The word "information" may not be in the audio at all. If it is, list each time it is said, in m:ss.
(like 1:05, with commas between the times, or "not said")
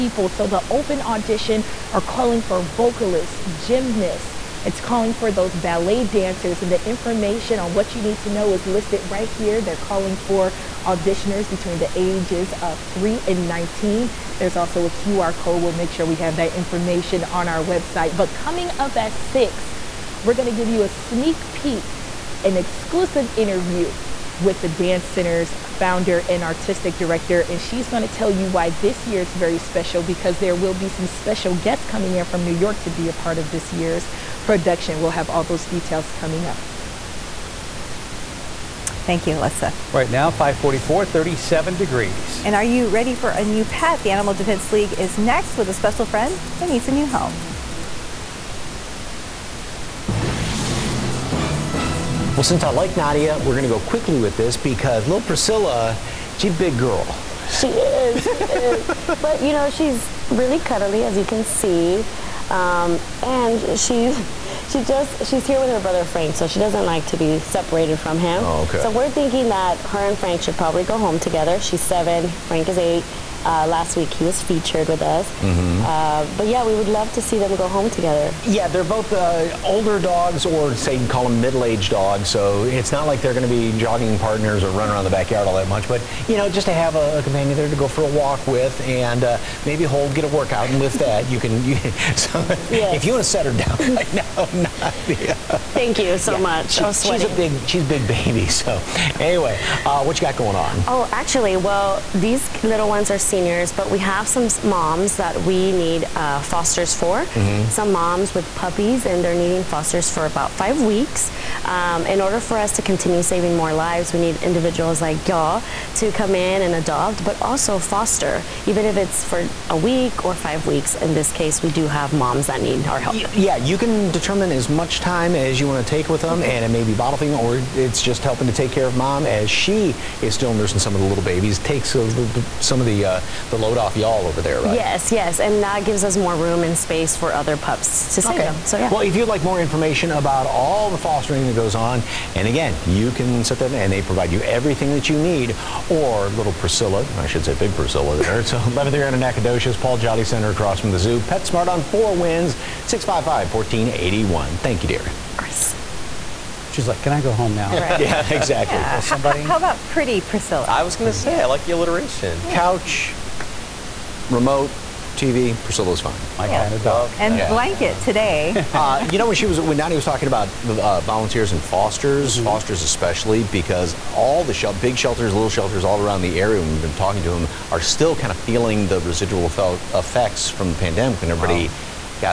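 0:06, 0:16, 2:19.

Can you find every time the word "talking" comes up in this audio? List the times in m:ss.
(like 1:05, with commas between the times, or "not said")
2:50, 2:57.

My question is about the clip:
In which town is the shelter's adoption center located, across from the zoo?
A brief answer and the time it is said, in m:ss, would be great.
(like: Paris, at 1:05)
Nacogdoches, at 2:29.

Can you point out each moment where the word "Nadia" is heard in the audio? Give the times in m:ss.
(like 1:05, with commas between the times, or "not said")
0:52, 1:35.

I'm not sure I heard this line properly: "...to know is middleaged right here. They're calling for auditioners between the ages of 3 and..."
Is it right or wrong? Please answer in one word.
wrong.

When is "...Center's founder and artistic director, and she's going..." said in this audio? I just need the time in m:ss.
0:25.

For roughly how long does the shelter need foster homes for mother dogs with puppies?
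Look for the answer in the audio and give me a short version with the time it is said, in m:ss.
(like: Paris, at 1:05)
5 weeks, at 1:50.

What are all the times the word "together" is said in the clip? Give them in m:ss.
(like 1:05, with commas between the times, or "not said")
1:11, 1:17.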